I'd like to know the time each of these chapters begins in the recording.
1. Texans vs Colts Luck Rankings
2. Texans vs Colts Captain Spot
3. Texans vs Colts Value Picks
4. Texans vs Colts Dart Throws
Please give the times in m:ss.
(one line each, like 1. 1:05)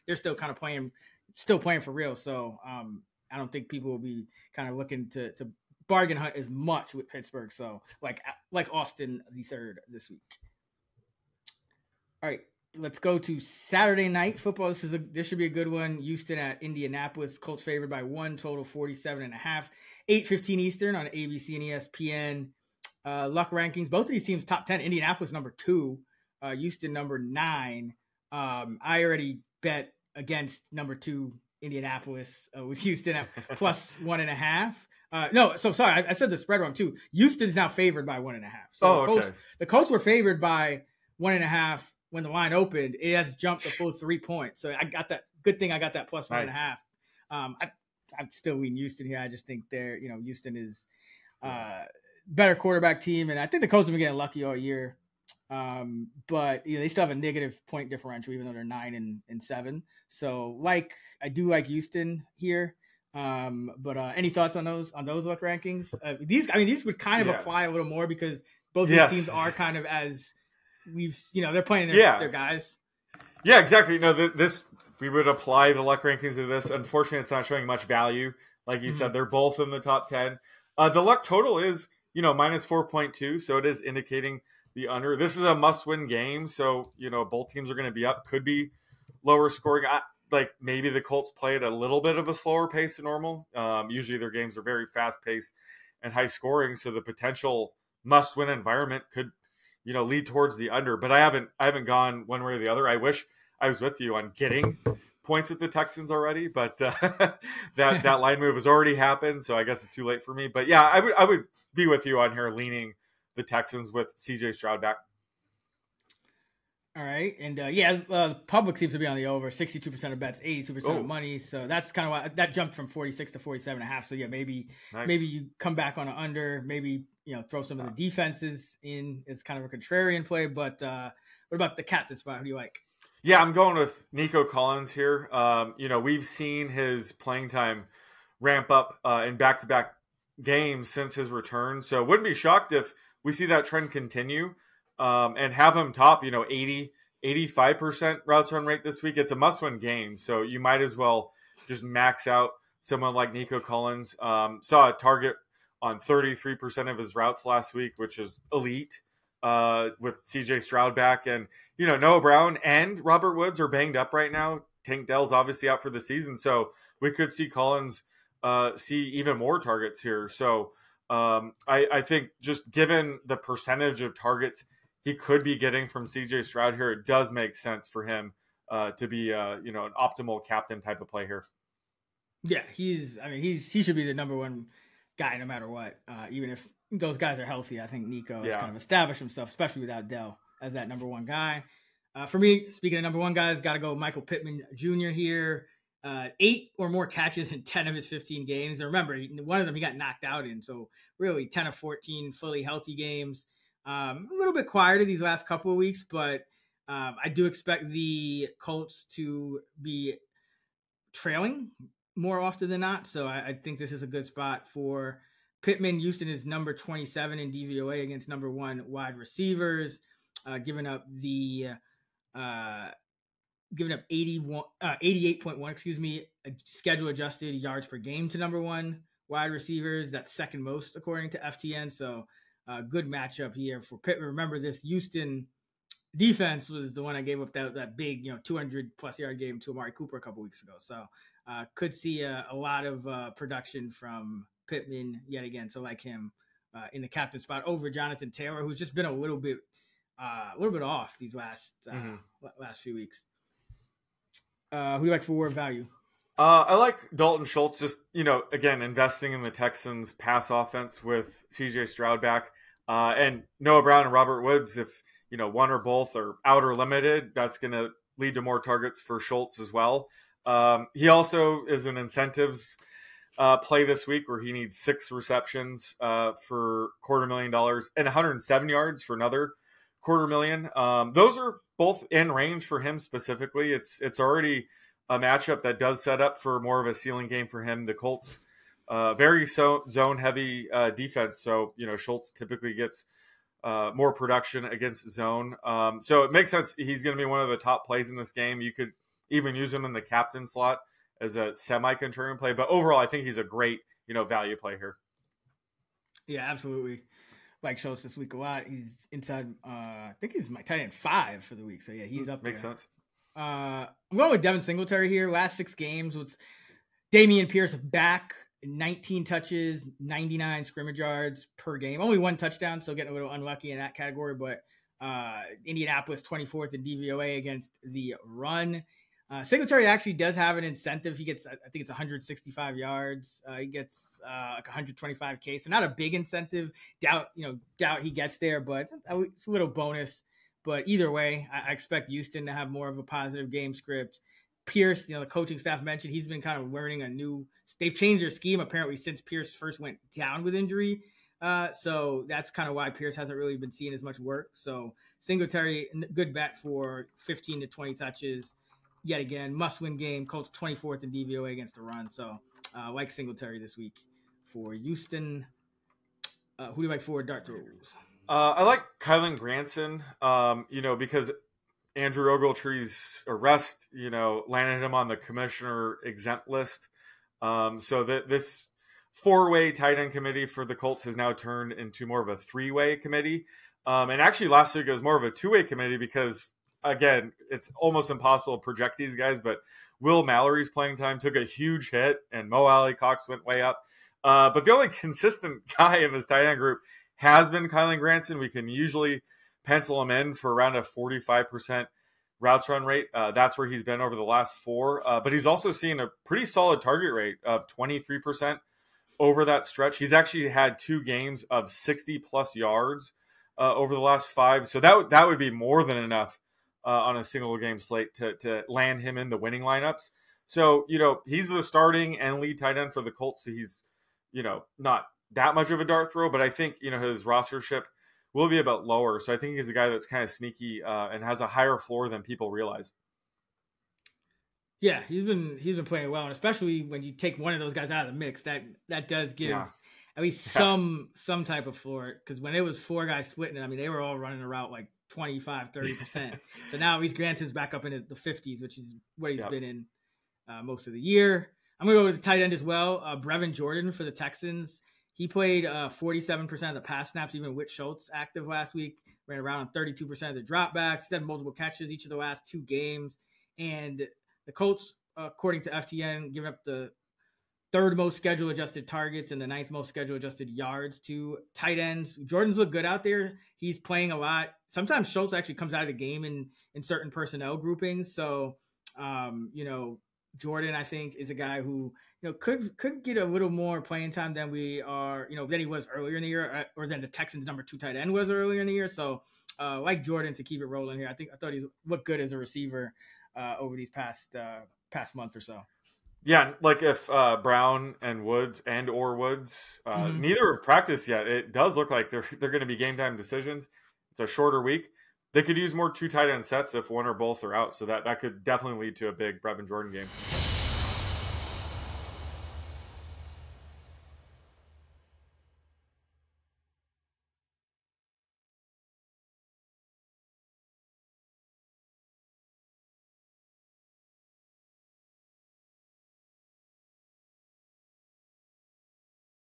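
1. 0:12
2. 2:12
3. 4:14
4. 6:05.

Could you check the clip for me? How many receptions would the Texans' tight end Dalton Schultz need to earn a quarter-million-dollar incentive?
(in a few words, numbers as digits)
6.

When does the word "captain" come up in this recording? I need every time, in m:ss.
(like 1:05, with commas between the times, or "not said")
2:11, 3:00, 4:07, 5:00.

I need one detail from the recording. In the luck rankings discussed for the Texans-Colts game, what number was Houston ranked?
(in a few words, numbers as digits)
9.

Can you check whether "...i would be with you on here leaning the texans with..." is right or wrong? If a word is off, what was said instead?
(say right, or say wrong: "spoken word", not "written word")
right.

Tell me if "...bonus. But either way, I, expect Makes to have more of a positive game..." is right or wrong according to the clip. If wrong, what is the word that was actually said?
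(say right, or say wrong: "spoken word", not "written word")
wrong: "Houston", not "Makes".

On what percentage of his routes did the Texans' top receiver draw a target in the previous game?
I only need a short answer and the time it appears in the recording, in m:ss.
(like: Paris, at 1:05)
33%, at 2:35.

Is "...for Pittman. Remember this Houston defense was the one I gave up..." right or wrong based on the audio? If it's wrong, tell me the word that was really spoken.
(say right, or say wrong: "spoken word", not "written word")
right.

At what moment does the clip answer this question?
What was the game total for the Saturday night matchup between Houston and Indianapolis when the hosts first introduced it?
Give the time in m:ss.
0:18.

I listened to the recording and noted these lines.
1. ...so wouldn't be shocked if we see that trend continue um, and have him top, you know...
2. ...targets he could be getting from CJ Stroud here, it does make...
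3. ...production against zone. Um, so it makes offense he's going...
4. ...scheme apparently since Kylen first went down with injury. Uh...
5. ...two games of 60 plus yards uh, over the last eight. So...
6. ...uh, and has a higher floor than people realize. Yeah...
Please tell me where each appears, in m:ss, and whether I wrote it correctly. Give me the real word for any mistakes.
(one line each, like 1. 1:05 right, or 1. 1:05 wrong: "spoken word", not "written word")
1. 2:21 right
2. 2:54 right
3. 4:54 wrong: "sense", not "offense"
4. 5:48 wrong: "Pierce", not "Kylen"
5. 6:50 wrong: "five", not "eight"
6. 7:10 right.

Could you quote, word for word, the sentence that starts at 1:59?
Sixty-two percent of bets, eighty-two percent of oh.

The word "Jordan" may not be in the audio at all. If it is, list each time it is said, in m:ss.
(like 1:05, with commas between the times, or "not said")
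7:33, 7:52, 8:00, 8:10, 8:29.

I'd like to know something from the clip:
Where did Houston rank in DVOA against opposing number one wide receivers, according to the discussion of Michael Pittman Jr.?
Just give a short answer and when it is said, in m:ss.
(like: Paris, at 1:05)
27, at 3:36.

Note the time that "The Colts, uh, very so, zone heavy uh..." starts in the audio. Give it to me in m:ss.
4:47.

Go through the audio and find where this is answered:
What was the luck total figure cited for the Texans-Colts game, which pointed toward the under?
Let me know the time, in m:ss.
1:22.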